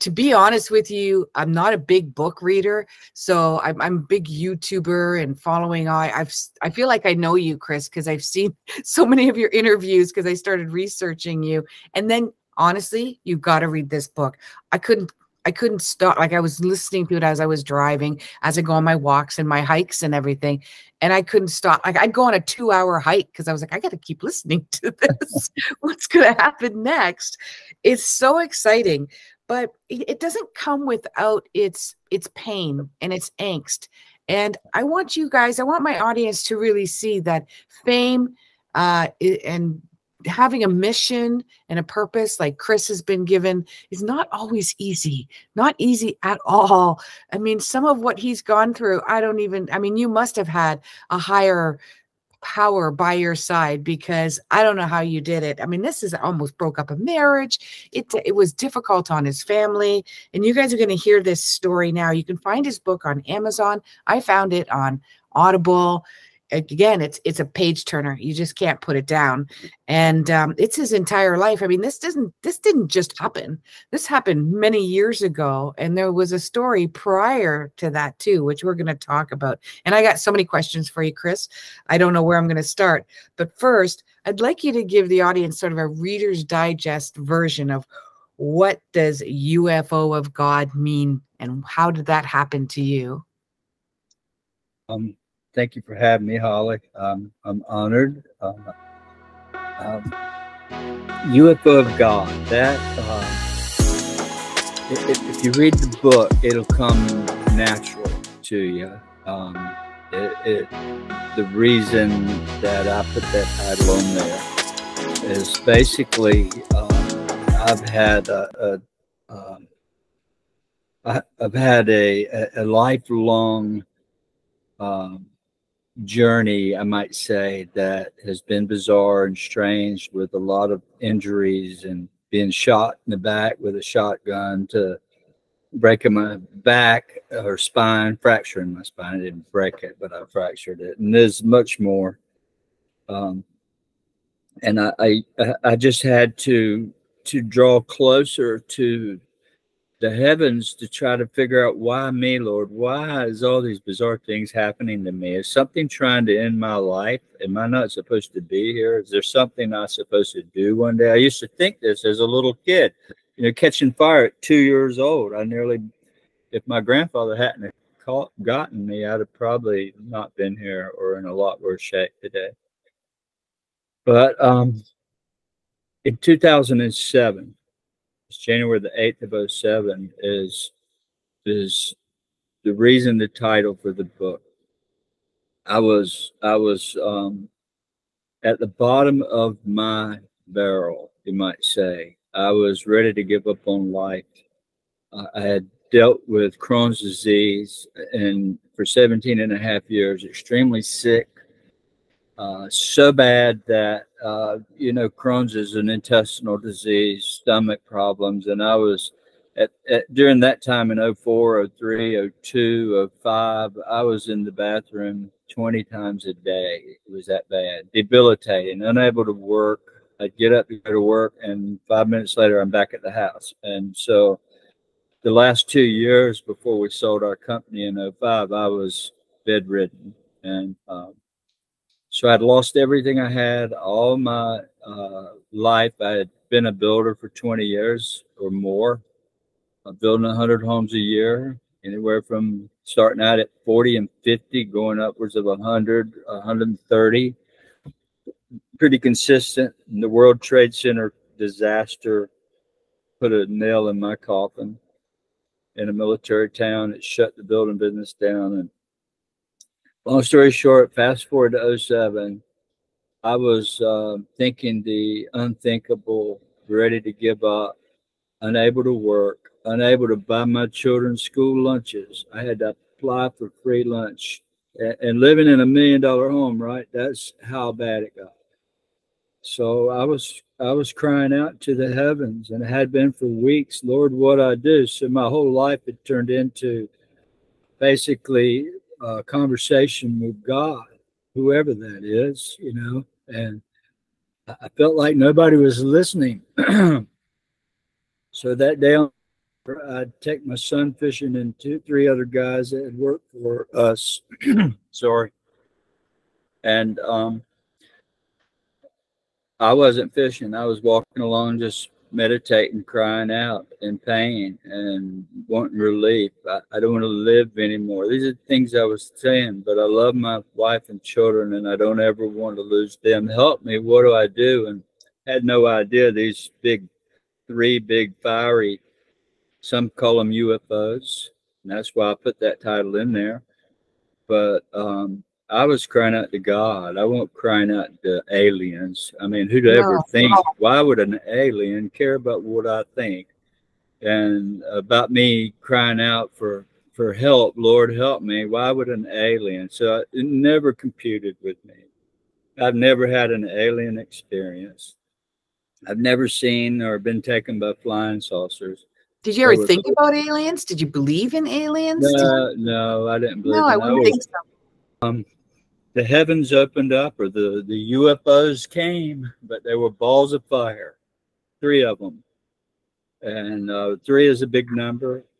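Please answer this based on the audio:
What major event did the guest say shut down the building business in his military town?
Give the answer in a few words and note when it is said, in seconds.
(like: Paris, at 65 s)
World Trade Center disaster, at 250 s.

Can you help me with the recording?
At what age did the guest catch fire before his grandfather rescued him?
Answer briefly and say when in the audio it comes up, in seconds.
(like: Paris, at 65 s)
2, at 164 s.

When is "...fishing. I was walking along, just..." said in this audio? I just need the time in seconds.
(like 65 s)
310 s.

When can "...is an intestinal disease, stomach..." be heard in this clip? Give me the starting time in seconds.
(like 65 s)
205 s.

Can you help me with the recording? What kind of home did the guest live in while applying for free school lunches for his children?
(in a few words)
million dollar home.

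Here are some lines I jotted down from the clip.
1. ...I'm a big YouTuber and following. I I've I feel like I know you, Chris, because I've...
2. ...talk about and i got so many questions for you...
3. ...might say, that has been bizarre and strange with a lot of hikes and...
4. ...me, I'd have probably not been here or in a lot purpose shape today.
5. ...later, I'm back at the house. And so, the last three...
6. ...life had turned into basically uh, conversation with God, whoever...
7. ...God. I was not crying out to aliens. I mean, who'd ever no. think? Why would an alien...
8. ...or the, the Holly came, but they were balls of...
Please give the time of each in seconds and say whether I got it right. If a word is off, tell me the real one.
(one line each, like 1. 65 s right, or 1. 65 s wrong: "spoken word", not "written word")
1. 3 s right
2. 78 s right
3. 126 s wrong: "injuries", not "hikes"
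4. 168 s wrong: "worse", not "purpose"
5. 222 s wrong: "two", not "three"
6. 285 s right
7. 336 s right
8. 367 s wrong: "UFOs", not "Holly".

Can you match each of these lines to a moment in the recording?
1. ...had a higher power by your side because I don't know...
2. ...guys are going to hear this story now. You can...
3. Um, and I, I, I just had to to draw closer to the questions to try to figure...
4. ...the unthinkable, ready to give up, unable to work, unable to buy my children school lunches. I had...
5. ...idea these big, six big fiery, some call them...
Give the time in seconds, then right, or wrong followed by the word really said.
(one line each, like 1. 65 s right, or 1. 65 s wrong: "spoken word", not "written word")
1. 50 s right
2. 60 s right
3. 143 s wrong: "heavens", not "questions"
4. 264 s right
5. 325 s wrong: "three", not "six".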